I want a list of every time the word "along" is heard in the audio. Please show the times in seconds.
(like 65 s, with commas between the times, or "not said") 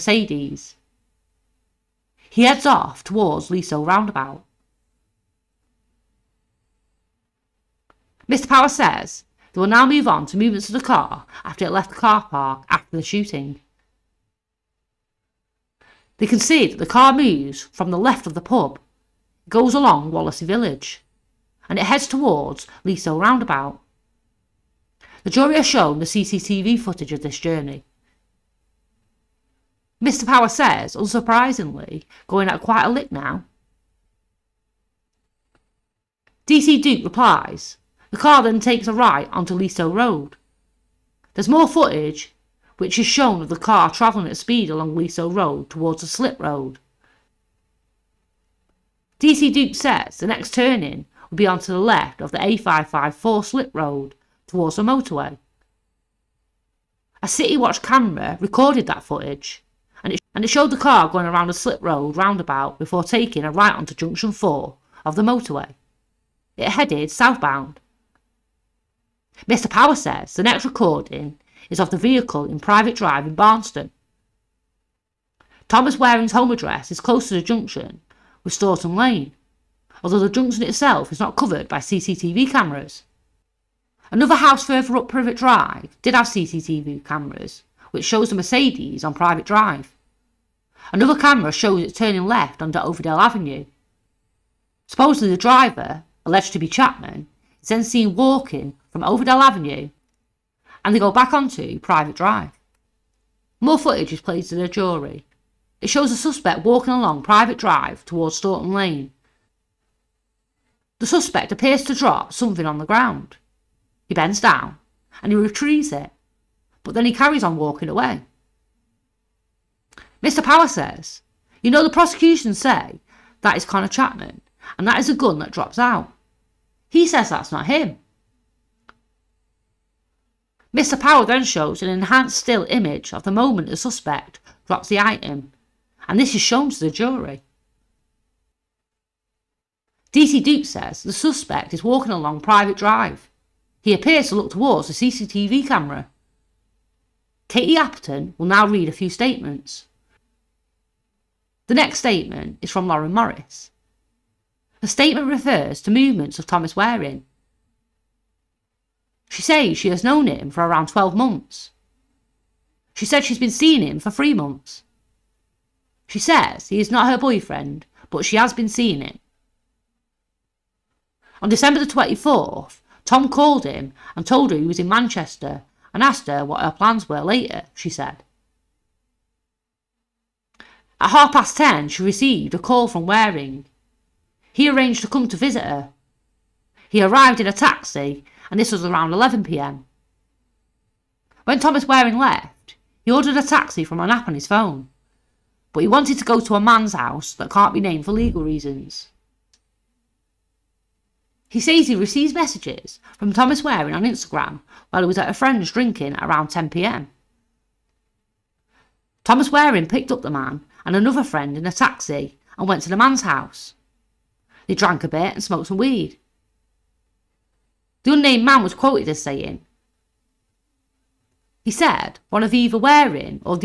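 19 s, 44 s, 106 s, 142 s.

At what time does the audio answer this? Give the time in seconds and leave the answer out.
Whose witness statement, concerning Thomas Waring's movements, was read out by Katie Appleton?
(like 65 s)
152 s.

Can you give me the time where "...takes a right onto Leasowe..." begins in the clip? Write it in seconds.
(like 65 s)
38 s.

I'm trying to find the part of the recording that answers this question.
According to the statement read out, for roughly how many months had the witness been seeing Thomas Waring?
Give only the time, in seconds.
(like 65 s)
164 s.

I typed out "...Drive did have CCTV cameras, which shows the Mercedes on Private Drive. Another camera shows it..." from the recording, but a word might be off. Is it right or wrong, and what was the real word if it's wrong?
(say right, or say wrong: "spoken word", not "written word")
right.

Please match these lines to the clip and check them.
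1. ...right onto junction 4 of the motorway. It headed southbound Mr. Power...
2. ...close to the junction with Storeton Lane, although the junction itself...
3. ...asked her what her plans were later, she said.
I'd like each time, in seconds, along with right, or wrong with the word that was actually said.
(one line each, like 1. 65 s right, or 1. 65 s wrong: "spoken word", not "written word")
1. 63 s right
2. 77 s right
3. 176 s right.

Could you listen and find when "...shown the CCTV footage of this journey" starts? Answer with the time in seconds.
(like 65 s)
25 s.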